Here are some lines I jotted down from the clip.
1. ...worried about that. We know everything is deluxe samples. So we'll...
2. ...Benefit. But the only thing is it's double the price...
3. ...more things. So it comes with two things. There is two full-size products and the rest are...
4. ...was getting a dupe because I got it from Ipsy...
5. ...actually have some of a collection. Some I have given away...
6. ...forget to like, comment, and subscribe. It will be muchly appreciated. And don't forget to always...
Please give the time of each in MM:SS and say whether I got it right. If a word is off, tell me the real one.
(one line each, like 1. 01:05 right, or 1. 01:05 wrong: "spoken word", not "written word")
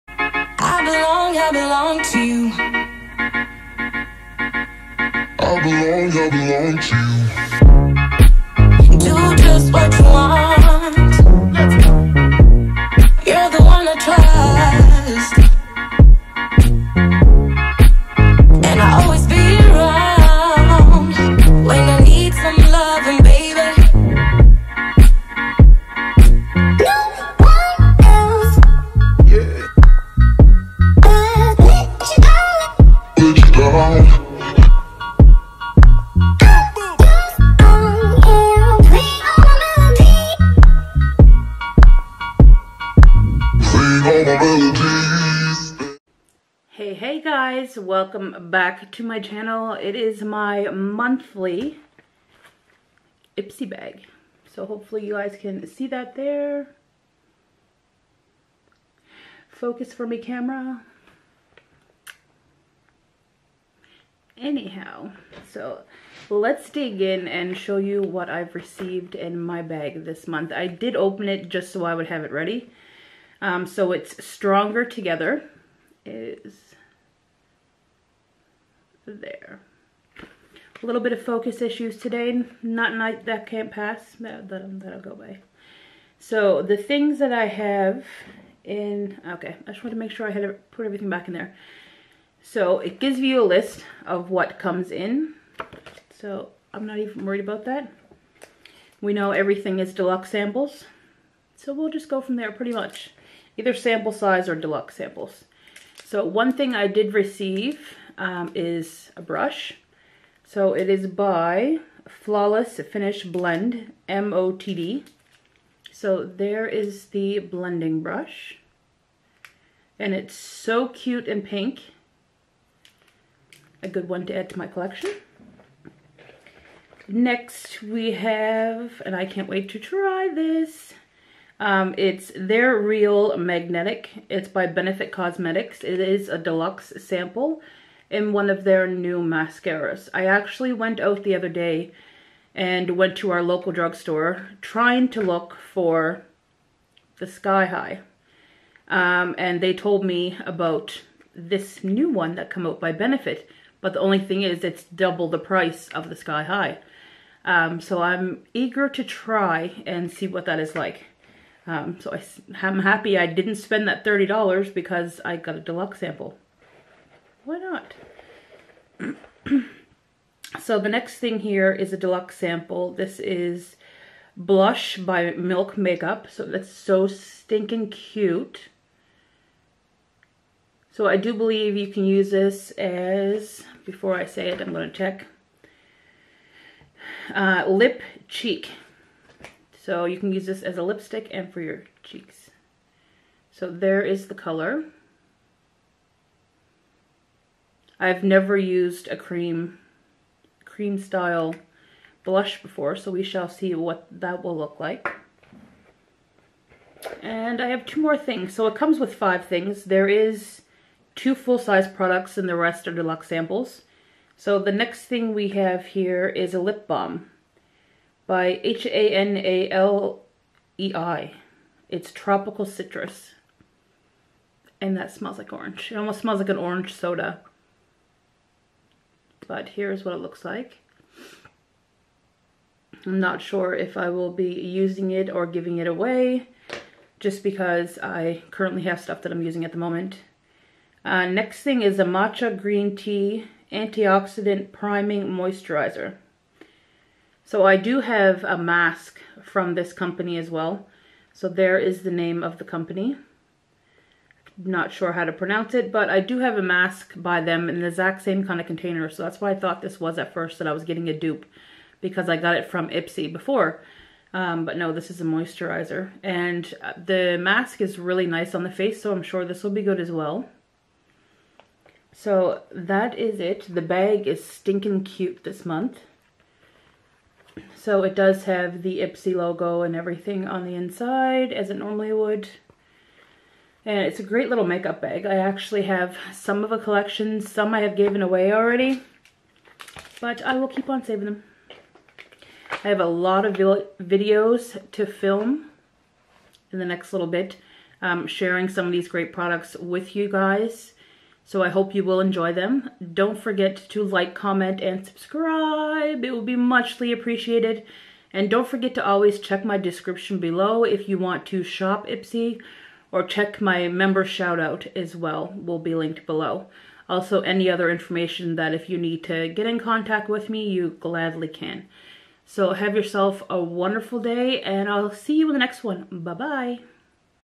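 1. 01:37 right
2. 02:32 right
3. 03:28 wrong: "five", not "two"
4. 04:20 right
5. 04:45 right
6. 05:03 right.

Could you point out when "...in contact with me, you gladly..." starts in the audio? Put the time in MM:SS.
05:19.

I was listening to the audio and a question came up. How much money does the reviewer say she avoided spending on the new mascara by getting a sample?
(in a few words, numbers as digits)
$30.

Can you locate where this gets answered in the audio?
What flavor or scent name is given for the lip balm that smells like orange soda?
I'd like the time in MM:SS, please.
03:42.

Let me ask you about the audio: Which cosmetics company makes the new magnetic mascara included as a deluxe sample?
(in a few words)
Benefit Cosmetics.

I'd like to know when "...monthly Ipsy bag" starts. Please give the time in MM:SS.
00:50.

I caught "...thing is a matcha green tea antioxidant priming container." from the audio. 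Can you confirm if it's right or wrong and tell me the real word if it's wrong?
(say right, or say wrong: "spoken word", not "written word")
wrong: "moisturizer", not "container".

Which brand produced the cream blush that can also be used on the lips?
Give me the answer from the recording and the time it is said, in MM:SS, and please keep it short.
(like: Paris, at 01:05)
Milk Makeup, at 02:55.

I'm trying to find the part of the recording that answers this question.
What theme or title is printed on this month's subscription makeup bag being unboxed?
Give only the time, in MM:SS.
01:14.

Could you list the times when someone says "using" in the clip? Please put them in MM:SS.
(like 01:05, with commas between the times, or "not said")
03:54, 03:59.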